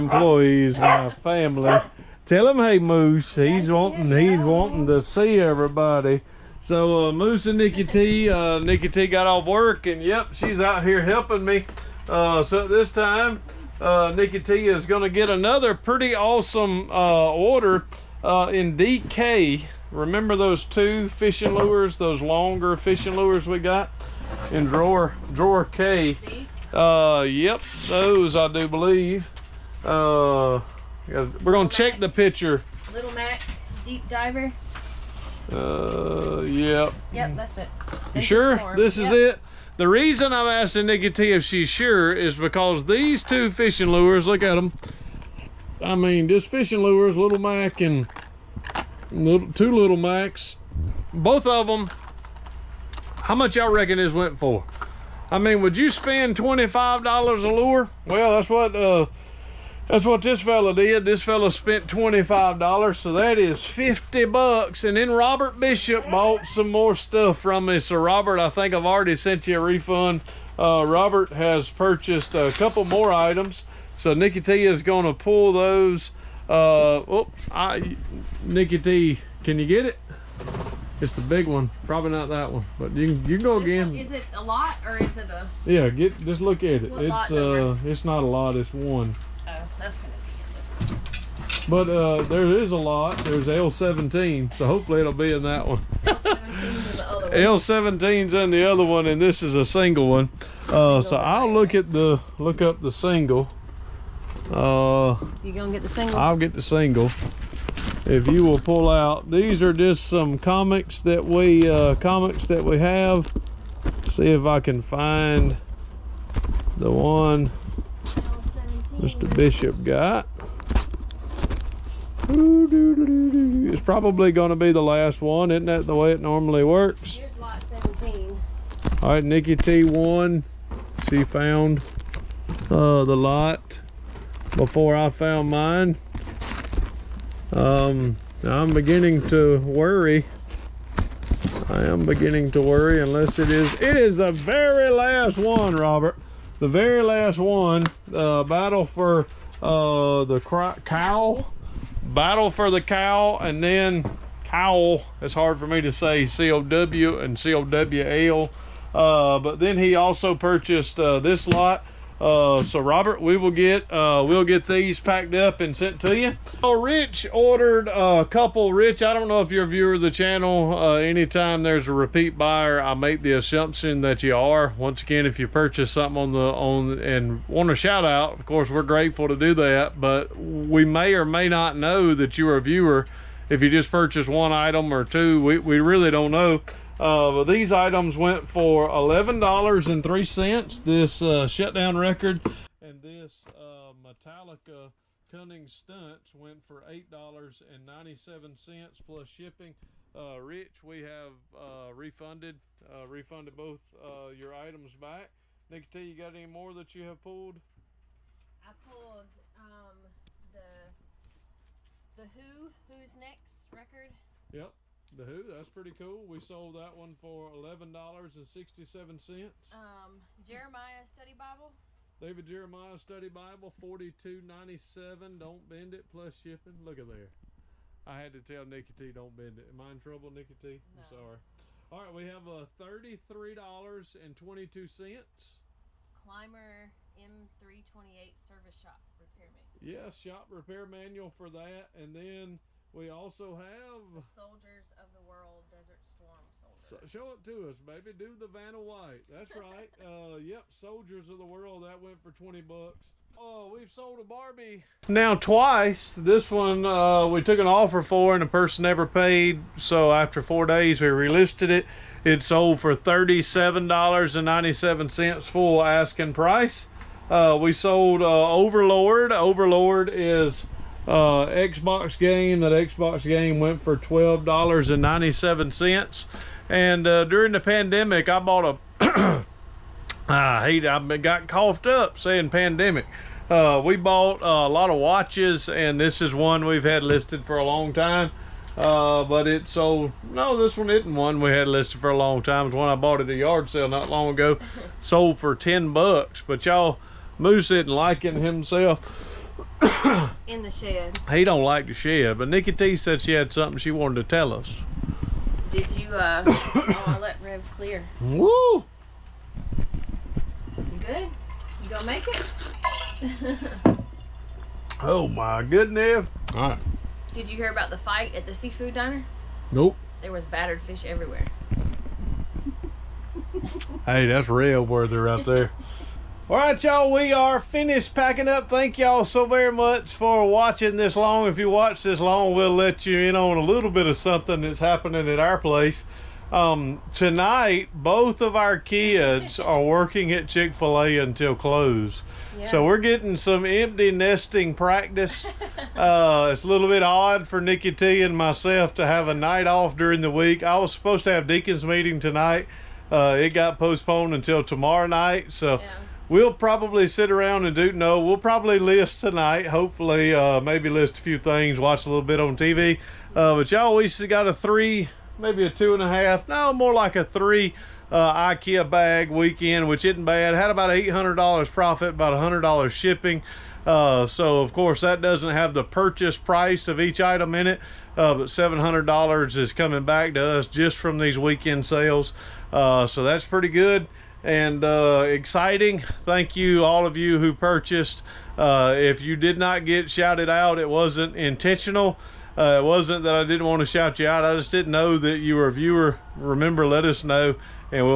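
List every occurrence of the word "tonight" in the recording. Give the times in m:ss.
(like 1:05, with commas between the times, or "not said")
5:37, 5:52, 5:59.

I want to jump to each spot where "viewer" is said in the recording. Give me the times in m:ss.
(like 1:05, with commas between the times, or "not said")
2:49, 3:02, 6:35.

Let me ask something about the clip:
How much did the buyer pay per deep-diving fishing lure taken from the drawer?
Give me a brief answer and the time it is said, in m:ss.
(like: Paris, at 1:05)
$25, at 0:56.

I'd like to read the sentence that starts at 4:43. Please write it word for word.
Uh, we bought a lot of watches and this is one we've had listed for a long time.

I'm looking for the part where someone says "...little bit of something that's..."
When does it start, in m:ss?
5:33.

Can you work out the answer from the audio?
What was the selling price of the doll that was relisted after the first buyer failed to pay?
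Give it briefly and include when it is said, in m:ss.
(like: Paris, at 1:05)
$37.97, at 4:22.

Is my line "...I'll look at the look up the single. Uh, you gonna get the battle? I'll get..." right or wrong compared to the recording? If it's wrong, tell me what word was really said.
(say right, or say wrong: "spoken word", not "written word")
wrong: "single", not "battle".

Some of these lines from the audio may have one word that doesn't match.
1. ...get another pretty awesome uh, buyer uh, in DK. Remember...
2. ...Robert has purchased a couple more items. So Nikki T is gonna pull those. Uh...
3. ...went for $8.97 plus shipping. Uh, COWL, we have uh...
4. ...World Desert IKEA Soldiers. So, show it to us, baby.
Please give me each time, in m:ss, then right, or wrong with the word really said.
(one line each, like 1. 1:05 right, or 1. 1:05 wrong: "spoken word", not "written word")
1. 0:15 wrong: "order", not "buyer"
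2. 1:10 right
3. 3:16 wrong: "Rich", not "COWL"
4. 4:05 wrong: "Storm", not "IKEA".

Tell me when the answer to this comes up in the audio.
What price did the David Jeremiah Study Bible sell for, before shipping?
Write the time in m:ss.
3:43.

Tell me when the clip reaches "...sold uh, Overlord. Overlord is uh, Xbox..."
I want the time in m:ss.
4:27.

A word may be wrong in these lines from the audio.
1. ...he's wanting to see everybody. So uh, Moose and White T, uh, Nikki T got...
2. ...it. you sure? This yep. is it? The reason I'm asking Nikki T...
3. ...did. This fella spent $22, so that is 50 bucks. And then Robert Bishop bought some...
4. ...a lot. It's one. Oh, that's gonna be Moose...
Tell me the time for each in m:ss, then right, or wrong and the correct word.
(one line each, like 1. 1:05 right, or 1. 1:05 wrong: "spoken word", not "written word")
1. 0:04 wrong: "Nikki", not "White"
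2. 0:37 right
3. 1:00 wrong: "25", not "22"
4. 1:28 wrong: "But", not "Moose".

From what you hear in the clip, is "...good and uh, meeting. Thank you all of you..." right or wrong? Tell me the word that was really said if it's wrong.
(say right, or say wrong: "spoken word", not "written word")
wrong: "exciting", not "meeting".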